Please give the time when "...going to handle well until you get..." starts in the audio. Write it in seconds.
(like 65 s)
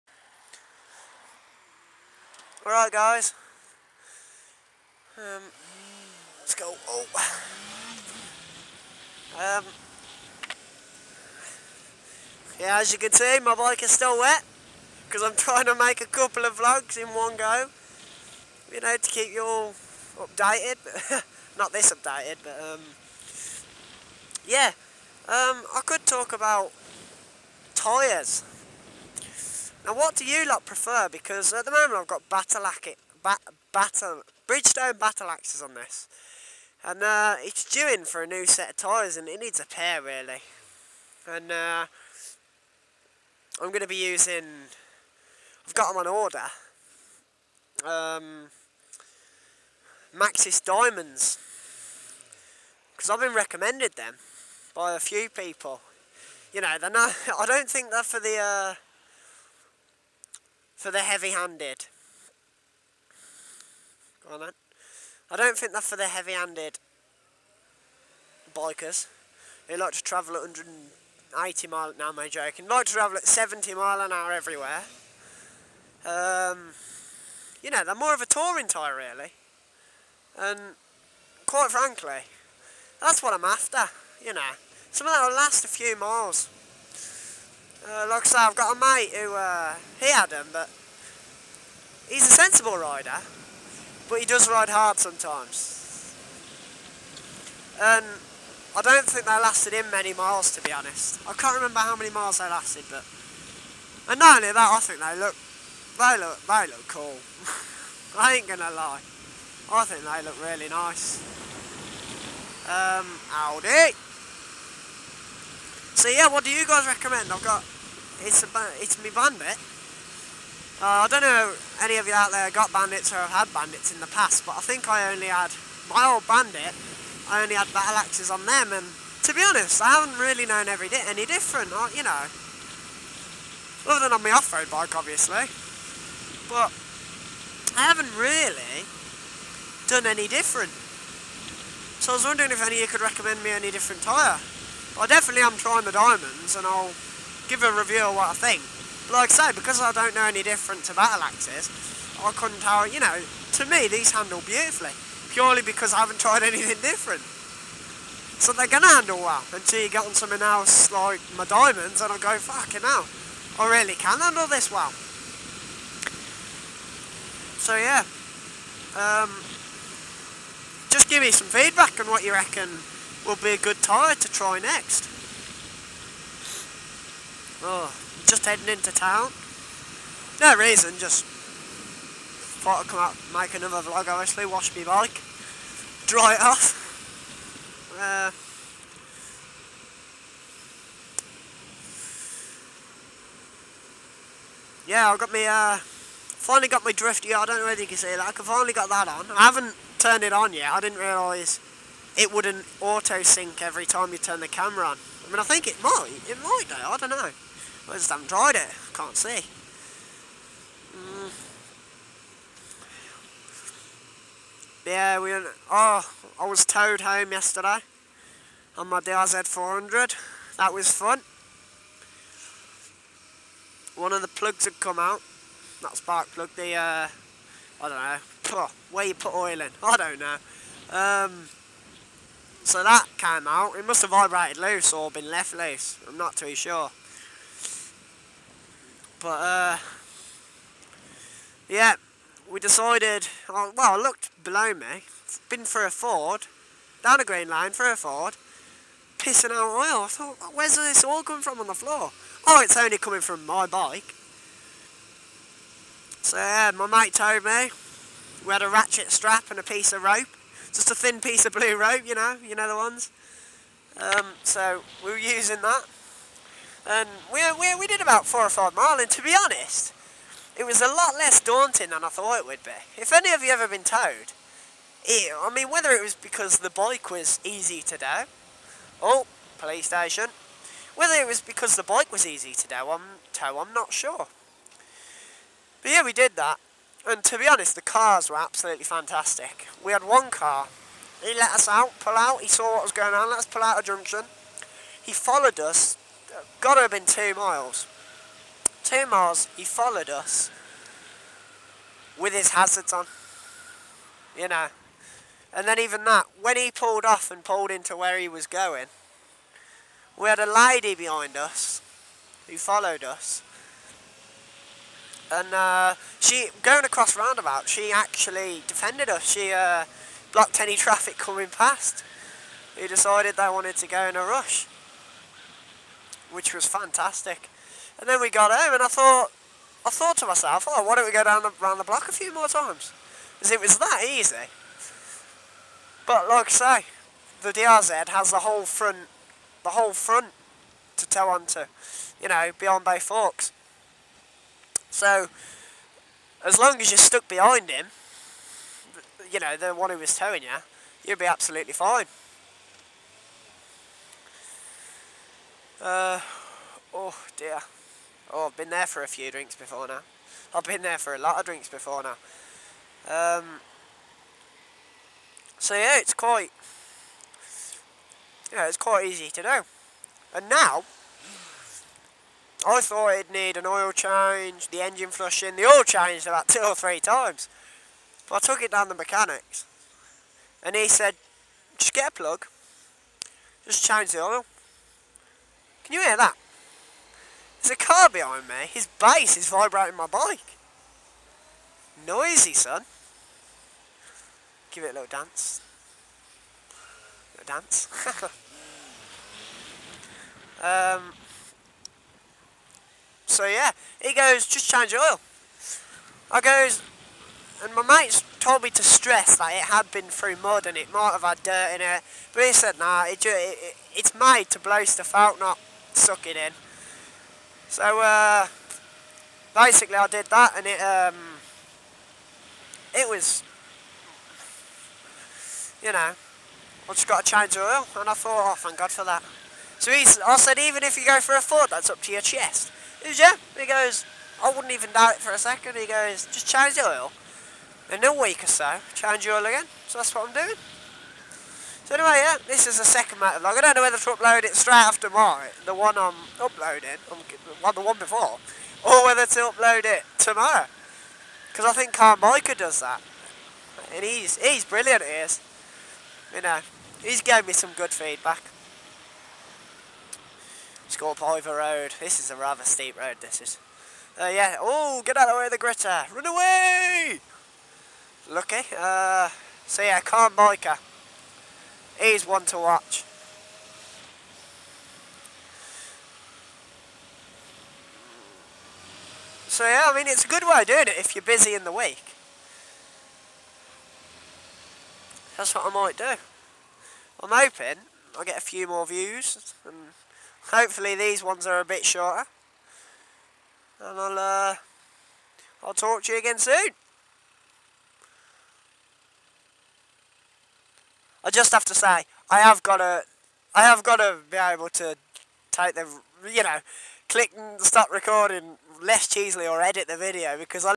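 158 s.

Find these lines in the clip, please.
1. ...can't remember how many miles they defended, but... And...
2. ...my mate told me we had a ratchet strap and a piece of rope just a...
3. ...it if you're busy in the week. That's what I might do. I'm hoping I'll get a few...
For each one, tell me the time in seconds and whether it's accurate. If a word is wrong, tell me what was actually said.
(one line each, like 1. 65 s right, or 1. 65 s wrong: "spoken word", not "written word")
1. 101 s wrong: "lasted", not "defended"
2. 256 s right
3. 480 s right.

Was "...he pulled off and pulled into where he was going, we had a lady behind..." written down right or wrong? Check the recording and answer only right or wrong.
right.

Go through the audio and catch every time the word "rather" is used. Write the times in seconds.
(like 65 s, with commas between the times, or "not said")
462 s.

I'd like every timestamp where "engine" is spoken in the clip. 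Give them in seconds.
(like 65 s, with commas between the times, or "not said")
374 s.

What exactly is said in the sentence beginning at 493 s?
And I'll, uh, I'll talk to you again soon.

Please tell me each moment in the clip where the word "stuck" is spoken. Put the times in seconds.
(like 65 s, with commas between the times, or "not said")
346 s.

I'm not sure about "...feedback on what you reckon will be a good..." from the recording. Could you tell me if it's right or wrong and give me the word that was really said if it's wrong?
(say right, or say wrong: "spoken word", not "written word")
right.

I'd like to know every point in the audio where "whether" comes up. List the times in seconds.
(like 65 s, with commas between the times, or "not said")
197 s, 275 s, 280 s, 443 s, 449 s.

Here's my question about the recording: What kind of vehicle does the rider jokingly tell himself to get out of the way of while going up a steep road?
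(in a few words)
Gritter.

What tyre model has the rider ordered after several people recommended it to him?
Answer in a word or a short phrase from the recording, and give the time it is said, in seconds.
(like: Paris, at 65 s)
Maxxis Diamonds, at 50 s.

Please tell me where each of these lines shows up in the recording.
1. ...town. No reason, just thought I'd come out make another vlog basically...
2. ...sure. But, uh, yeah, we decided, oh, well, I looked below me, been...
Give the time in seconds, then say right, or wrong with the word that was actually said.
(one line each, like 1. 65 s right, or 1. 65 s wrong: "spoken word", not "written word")
1. 178 s wrong: "obviously", not "basically"
2. 236 s right.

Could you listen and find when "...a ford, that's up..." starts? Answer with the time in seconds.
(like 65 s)
431 s.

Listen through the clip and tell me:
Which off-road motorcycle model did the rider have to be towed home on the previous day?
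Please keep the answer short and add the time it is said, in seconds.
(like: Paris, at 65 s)
DRZ 400, at 218 s.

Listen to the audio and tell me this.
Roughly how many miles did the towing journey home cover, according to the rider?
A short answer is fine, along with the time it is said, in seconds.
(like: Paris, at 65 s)
4 or 5 miles, at 268 s.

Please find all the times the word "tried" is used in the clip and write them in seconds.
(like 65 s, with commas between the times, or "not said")
156 s, 208 s.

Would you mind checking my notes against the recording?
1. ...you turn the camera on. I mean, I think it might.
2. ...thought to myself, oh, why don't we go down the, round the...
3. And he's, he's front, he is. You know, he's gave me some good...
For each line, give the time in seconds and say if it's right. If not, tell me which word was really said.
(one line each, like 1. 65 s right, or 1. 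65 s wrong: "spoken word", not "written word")
1. 204 s right
2. 329 s right
3. 453 s wrong: "brilliant", not "front".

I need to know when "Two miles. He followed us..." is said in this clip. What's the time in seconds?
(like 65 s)
298 s.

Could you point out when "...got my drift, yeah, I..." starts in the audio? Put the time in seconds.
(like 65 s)
196 s.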